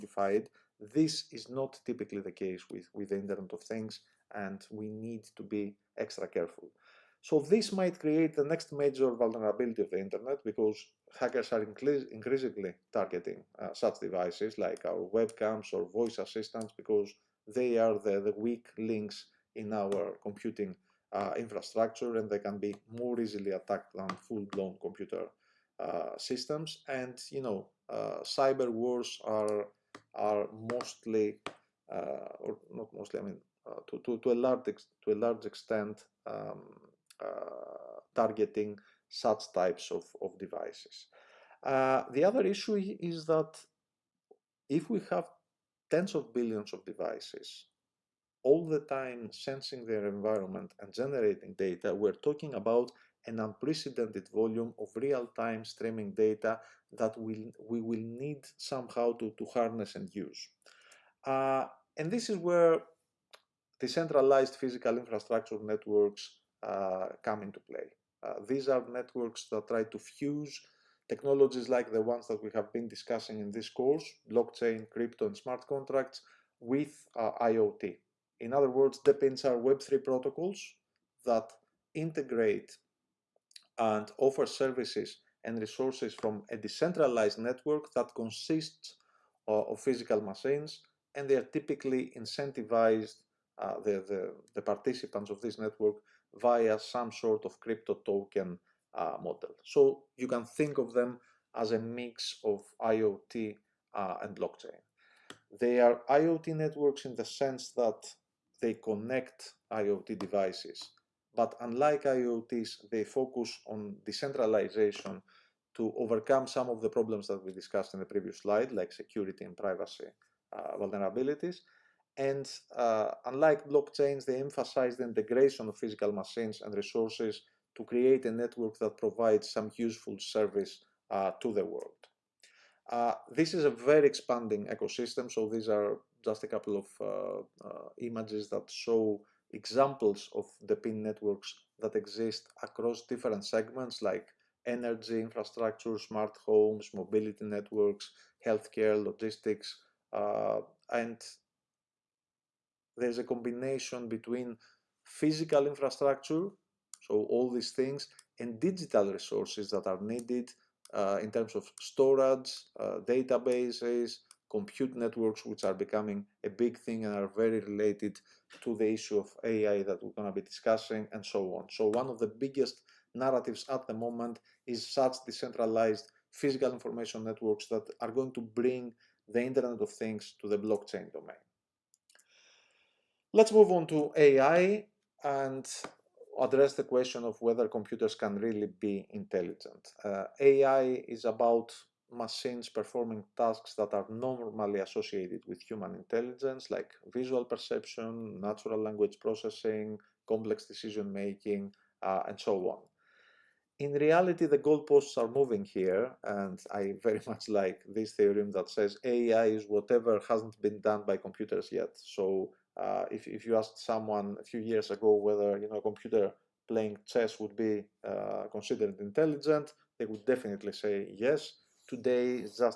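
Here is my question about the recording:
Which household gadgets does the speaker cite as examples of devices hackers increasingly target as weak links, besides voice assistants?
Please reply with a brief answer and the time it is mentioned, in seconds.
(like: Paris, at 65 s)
webcams, at 15 s.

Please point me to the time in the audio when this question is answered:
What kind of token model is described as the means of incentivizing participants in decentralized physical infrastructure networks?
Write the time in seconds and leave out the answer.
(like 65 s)
97 s.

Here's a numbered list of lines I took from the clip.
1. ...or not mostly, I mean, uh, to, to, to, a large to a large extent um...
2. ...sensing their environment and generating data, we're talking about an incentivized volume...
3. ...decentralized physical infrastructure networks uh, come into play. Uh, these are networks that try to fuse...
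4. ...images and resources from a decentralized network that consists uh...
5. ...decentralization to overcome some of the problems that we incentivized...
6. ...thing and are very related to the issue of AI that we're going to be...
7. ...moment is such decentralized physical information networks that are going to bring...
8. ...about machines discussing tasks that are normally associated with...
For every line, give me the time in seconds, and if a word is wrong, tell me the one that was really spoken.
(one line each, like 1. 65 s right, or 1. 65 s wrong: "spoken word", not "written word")
1. 32 s right
2. 49 s wrong: "unprecedented", not "incentivized"
3. 63 s right
4. 84 s wrong: "services", not "images"
5. 114 s wrong: "discussed", not "incentivized"
6. 166 s right
7. 173 s right
8. 191 s wrong: "performing", not "discussing".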